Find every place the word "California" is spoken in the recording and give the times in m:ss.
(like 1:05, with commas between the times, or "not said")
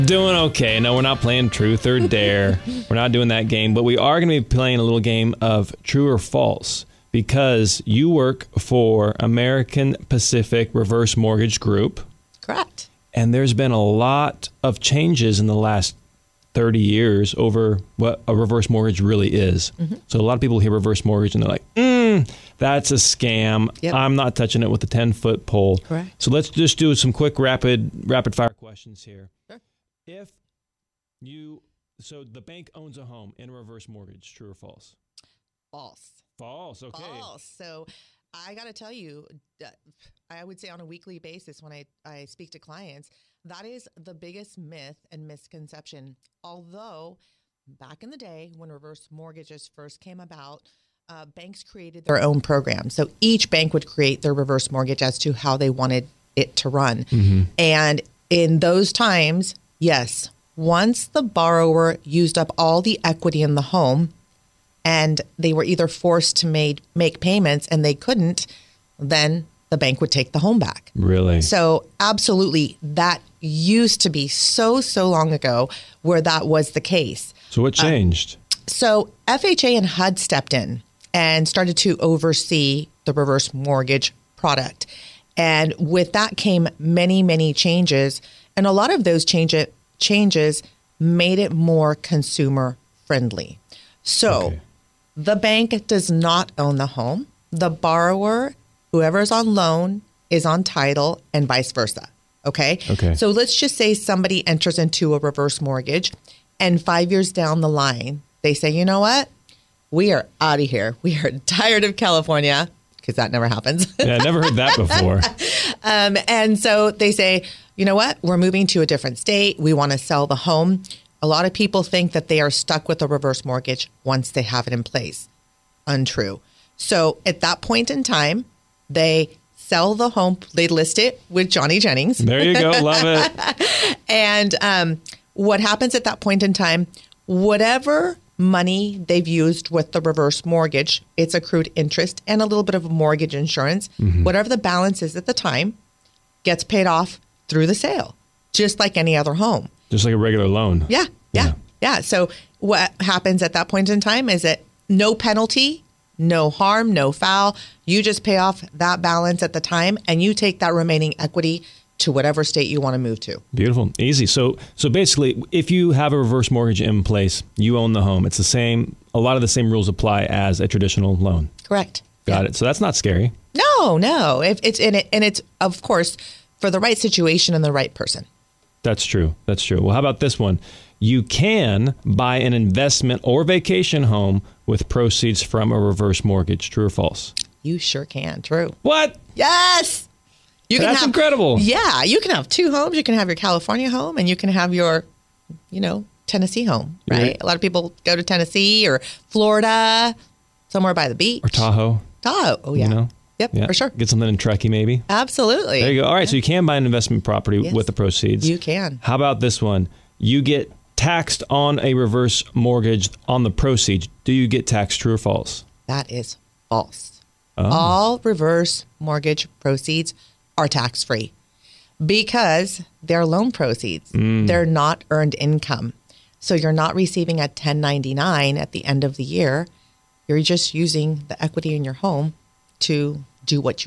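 1:51, 3:13.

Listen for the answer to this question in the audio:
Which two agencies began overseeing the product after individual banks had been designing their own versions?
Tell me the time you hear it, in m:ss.
1:19.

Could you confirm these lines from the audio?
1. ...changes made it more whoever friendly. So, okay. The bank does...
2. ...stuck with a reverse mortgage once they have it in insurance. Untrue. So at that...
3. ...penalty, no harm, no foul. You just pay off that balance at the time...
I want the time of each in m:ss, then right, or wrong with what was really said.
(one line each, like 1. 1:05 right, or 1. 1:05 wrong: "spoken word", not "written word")
1. 1:29 wrong: "consumer", not "whoever"
2. 2:02 wrong: "place", not "insurance"
3. 2:35 right.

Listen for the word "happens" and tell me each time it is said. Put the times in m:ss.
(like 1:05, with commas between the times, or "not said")
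1:53, 2:15, 2:33.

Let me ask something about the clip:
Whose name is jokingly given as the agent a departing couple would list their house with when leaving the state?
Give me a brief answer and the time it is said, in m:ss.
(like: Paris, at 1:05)
Johnny Jennings, at 2:11.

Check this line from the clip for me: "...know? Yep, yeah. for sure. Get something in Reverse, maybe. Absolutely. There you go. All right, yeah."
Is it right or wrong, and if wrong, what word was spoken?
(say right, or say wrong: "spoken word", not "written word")
wrong: "Truckee", not "Reverse".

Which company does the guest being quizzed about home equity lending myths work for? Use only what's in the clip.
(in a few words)
American Pacific Reverse Mortgage Group.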